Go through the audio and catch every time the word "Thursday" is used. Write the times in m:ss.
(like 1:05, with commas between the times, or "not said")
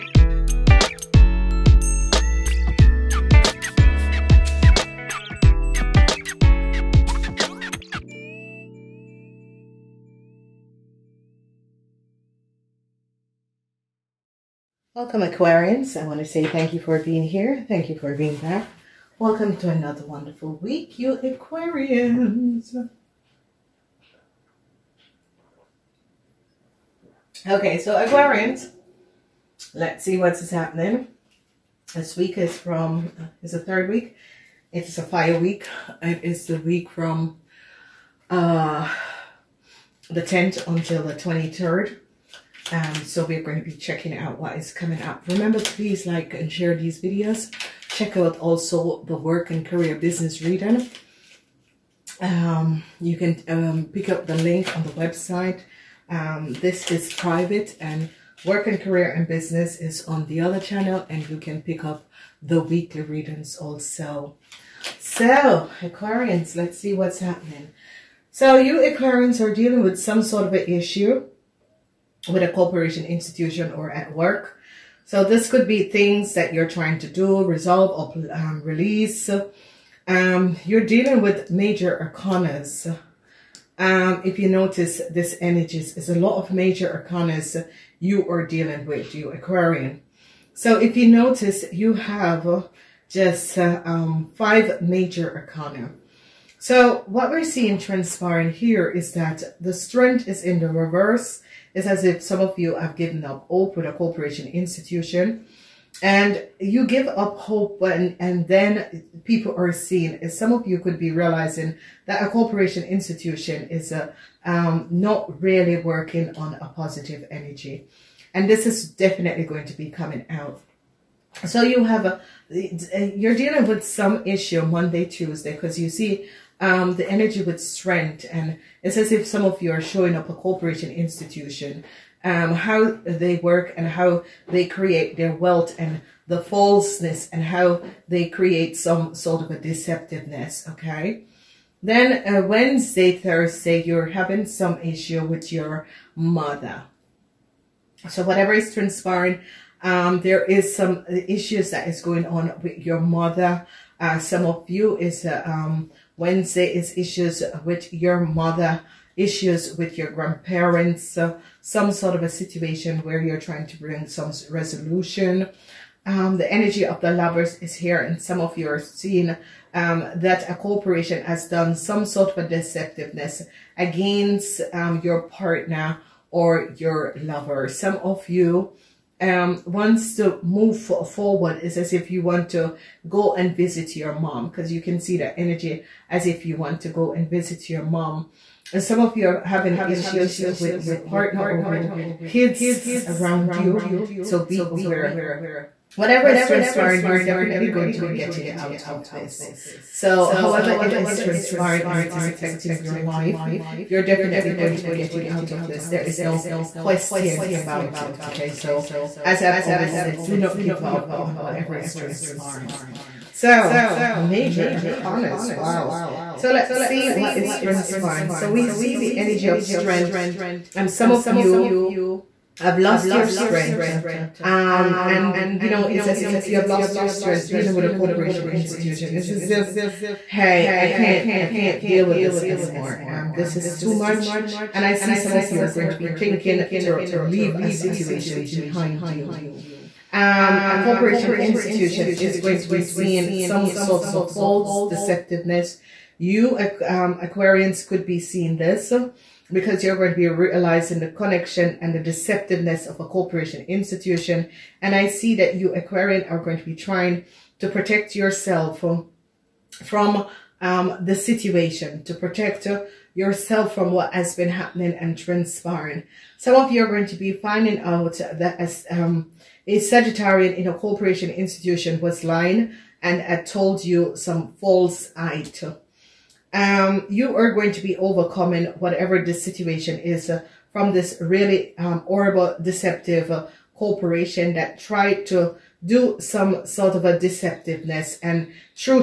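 2:23.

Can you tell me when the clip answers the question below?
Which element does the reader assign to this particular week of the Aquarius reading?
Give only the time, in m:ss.
0:35.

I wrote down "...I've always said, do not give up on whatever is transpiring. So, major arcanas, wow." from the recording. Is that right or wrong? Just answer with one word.
right.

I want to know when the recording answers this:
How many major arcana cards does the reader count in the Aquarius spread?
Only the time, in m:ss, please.
1:34.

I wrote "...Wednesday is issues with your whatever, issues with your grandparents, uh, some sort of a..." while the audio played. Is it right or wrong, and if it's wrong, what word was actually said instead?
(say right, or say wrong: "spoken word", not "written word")
wrong: "mother", not "whatever".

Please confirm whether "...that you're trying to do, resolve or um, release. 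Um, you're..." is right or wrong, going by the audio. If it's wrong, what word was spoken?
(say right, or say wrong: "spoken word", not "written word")
right.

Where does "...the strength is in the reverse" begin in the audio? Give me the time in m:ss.
1:39.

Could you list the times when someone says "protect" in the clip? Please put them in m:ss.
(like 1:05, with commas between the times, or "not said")
4:17, 4:22.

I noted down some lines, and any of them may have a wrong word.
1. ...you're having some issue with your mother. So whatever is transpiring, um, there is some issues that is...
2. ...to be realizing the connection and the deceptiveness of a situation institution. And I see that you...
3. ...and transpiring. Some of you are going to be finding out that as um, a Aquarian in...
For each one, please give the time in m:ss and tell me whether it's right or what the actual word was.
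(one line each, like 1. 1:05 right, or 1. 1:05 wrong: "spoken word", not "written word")
1. 2:23 right
2. 4:10 wrong: "corporation", not "situation"
3. 4:24 wrong: "Sagittarian", not "Aquarian".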